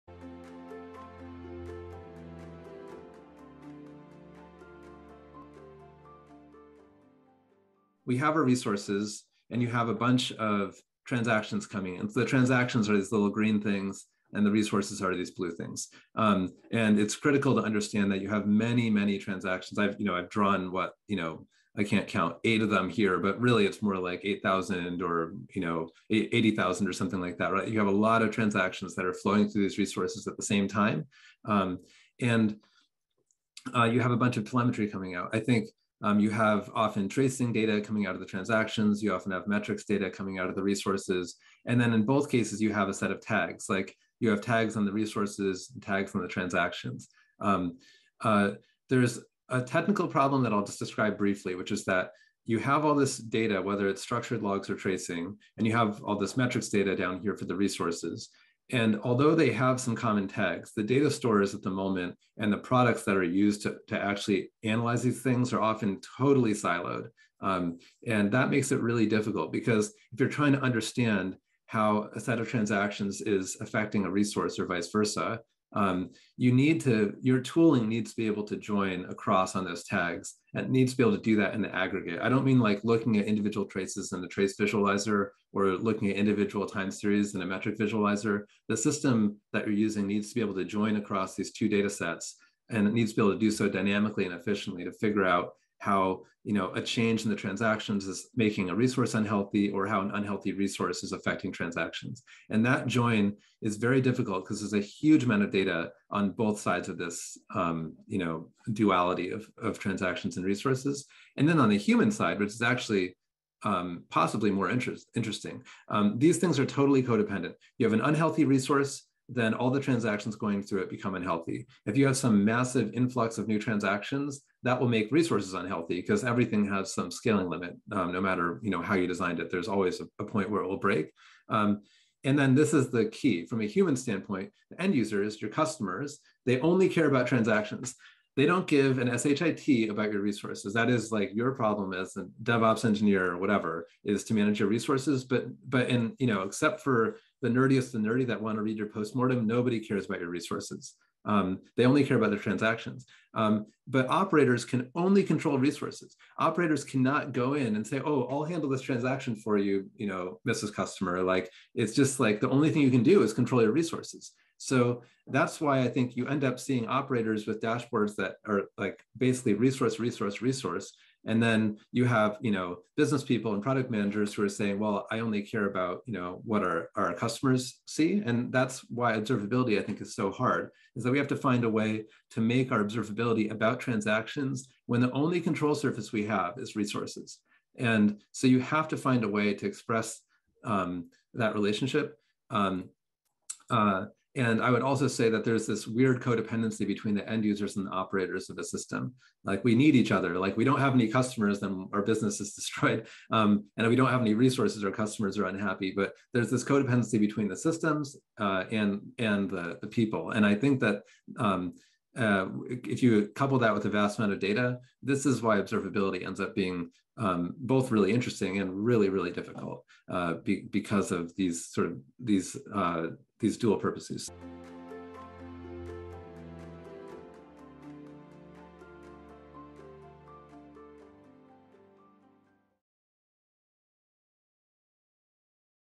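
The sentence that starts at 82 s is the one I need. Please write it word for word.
I don't mean like looking at individual traces in the trace visualizer or looking at individual time series in a metric visualizer.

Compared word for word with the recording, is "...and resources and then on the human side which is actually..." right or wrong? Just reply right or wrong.
right.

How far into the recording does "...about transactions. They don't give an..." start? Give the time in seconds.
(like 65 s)
137 s.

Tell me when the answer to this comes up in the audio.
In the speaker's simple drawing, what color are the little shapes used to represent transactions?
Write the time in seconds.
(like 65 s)
13 s.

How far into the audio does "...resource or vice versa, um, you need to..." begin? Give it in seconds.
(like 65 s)
74 s.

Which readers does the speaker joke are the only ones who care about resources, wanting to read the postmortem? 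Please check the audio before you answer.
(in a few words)
The nerdiest.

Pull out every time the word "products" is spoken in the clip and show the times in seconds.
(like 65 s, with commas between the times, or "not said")
62 s, 173 s.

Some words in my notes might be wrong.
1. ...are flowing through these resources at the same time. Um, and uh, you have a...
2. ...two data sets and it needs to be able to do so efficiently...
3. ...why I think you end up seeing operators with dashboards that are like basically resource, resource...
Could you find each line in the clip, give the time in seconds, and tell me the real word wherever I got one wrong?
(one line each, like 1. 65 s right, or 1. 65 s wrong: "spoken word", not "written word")
1. 29 s right
2. 91 s wrong: "dynamically", not "efficiently"
3. 165 s right.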